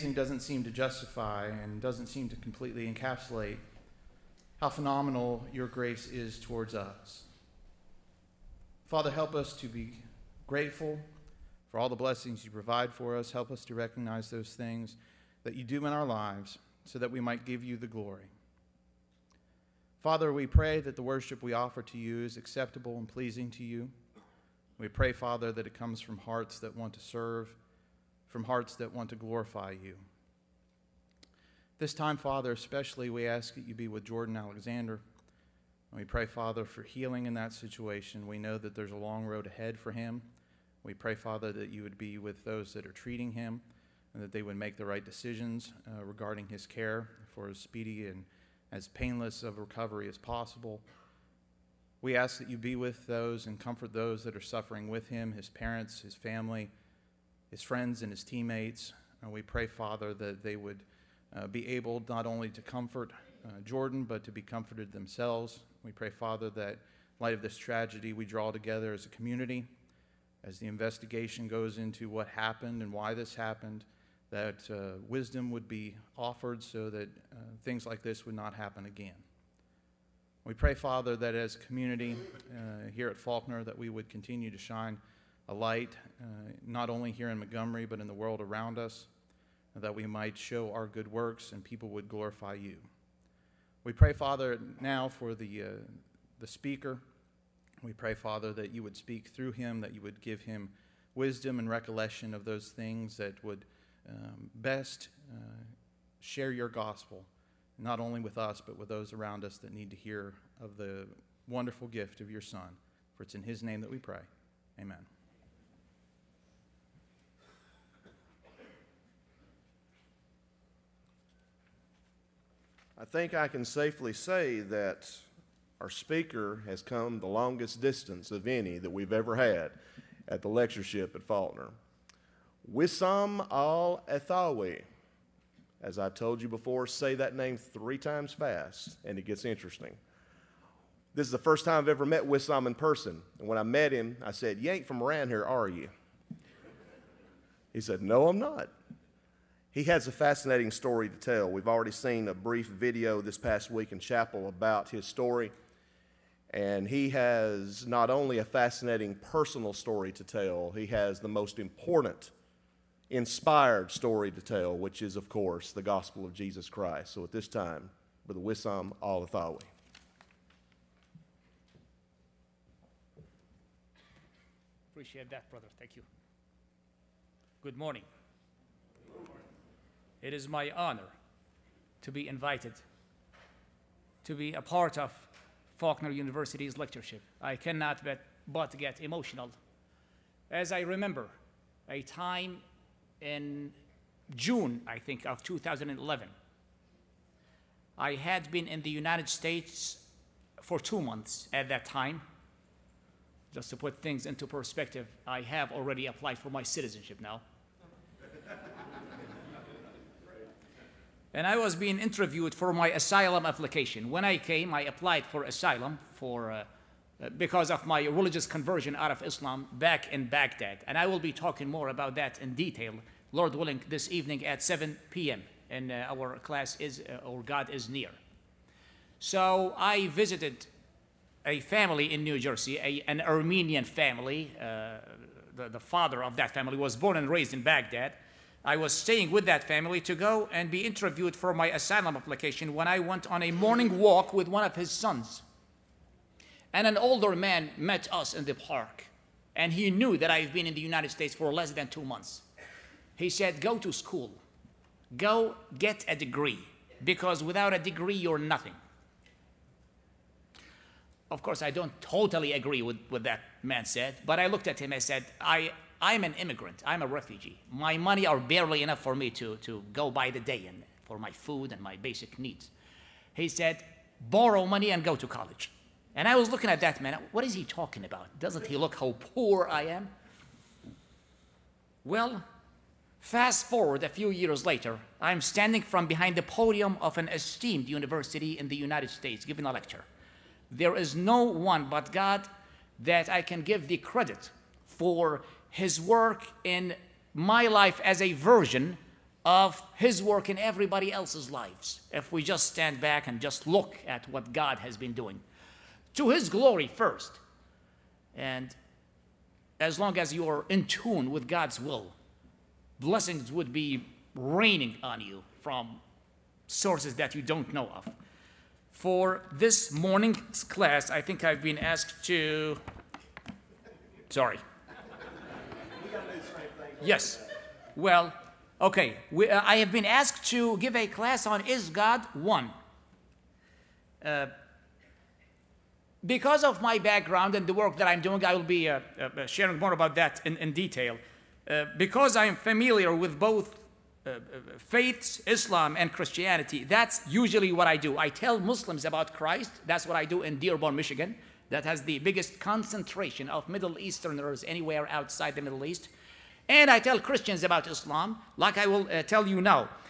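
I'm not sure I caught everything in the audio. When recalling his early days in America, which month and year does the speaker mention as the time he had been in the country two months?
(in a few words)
June 2011.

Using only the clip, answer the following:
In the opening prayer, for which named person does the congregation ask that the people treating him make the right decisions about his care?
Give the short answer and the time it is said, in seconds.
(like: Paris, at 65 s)
Jordan Alexander, at 34 s.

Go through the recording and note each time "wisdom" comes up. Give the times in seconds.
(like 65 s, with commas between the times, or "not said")
75 s, 101 s.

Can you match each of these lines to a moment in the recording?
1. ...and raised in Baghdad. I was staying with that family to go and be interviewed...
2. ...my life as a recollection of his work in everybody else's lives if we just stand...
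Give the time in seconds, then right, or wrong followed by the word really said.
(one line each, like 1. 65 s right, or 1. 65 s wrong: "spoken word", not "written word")
1. 237 s right
2. 297 s wrong: "version", not "recollection".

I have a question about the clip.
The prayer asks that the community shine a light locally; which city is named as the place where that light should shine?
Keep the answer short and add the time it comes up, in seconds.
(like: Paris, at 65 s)
Montgomery, at 87 s.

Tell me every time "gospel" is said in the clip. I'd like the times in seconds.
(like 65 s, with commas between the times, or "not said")
106 s, 165 s.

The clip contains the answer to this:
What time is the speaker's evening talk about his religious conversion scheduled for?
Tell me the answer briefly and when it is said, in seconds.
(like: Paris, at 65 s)
7 p.m., at 224 s.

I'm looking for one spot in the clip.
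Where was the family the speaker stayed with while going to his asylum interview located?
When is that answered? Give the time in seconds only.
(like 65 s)
232 s.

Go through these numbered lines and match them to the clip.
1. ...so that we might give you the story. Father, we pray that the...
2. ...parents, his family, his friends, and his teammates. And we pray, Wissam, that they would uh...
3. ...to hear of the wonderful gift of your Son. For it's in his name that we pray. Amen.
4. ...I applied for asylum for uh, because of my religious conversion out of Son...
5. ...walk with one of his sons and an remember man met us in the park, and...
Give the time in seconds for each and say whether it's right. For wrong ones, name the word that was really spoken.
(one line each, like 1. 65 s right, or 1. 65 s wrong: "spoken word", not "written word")
1. 16 s wrong: "glory", not "story"
2. 55 s wrong: "Father", not "Wissam"
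3. 109 s right
4. 214 s wrong: "Islam", not "Son"
5. 243 s wrong: "older", not "remember".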